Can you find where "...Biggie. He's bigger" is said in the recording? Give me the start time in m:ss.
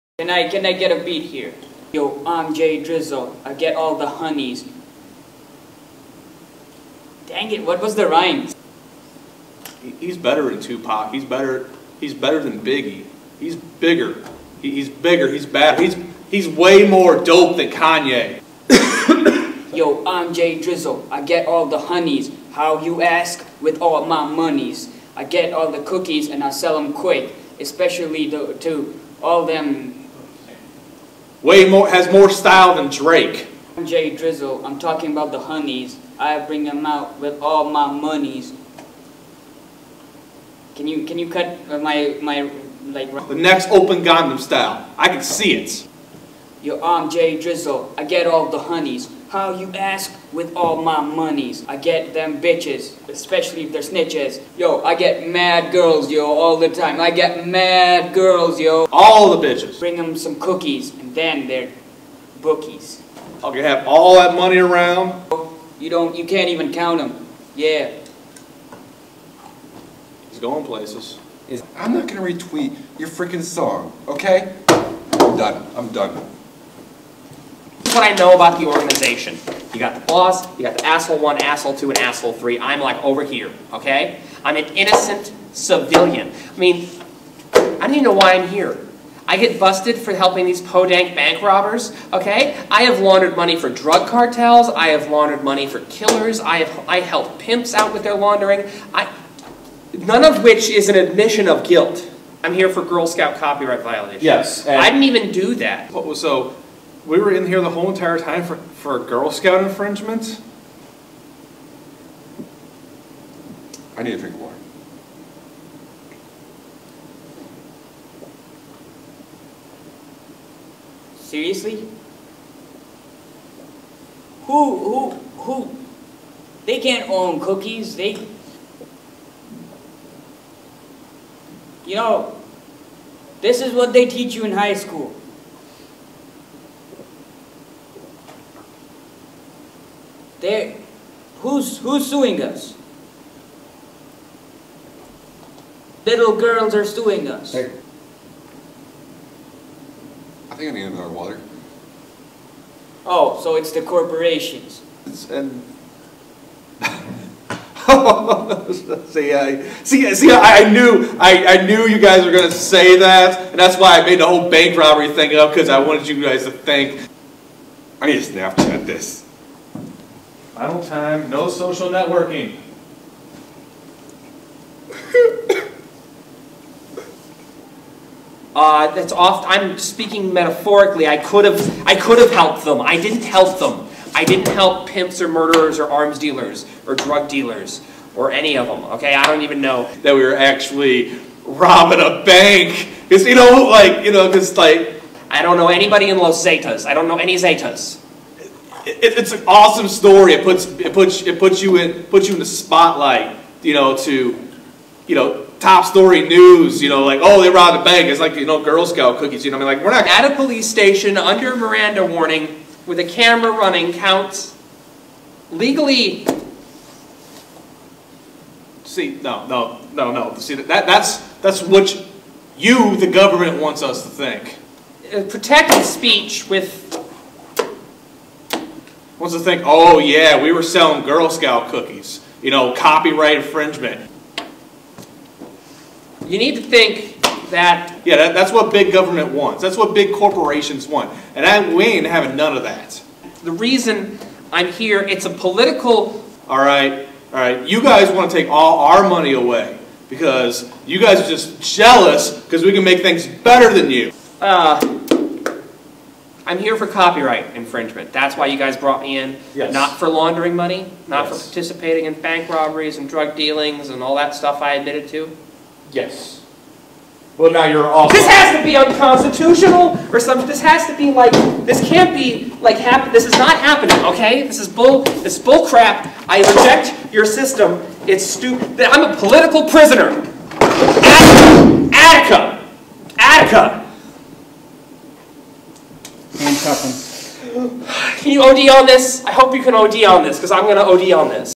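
0:12.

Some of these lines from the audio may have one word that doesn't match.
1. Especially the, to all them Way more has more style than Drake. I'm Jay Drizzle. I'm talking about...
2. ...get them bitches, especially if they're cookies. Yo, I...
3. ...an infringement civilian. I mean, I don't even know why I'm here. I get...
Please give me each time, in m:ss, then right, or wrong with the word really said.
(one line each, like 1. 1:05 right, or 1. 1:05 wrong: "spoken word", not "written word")
1. 0:27 right
2. 0:51 wrong: "snitches", not "cookies"
3. 1:24 wrong: "innocent", not "infringement".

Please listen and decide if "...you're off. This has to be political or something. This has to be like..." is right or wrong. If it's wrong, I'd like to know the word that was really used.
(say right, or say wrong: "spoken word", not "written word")
wrong: "unconstitutional", not "political".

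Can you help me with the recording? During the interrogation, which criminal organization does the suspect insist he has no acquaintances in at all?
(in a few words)
Los Zetas.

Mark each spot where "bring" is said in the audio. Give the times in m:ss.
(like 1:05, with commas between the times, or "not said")
0:36, 0:59.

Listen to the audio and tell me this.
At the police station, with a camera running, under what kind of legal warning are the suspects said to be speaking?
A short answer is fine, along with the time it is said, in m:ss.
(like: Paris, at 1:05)
Miranda warning, at 3:31.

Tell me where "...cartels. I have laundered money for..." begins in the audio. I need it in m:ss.
1:34.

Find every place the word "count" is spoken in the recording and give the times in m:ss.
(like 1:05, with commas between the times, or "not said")
1:06, 3:33.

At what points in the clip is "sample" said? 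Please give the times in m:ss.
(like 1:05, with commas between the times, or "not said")
not said.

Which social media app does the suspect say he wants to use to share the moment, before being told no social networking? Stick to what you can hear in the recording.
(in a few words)
Snapchat.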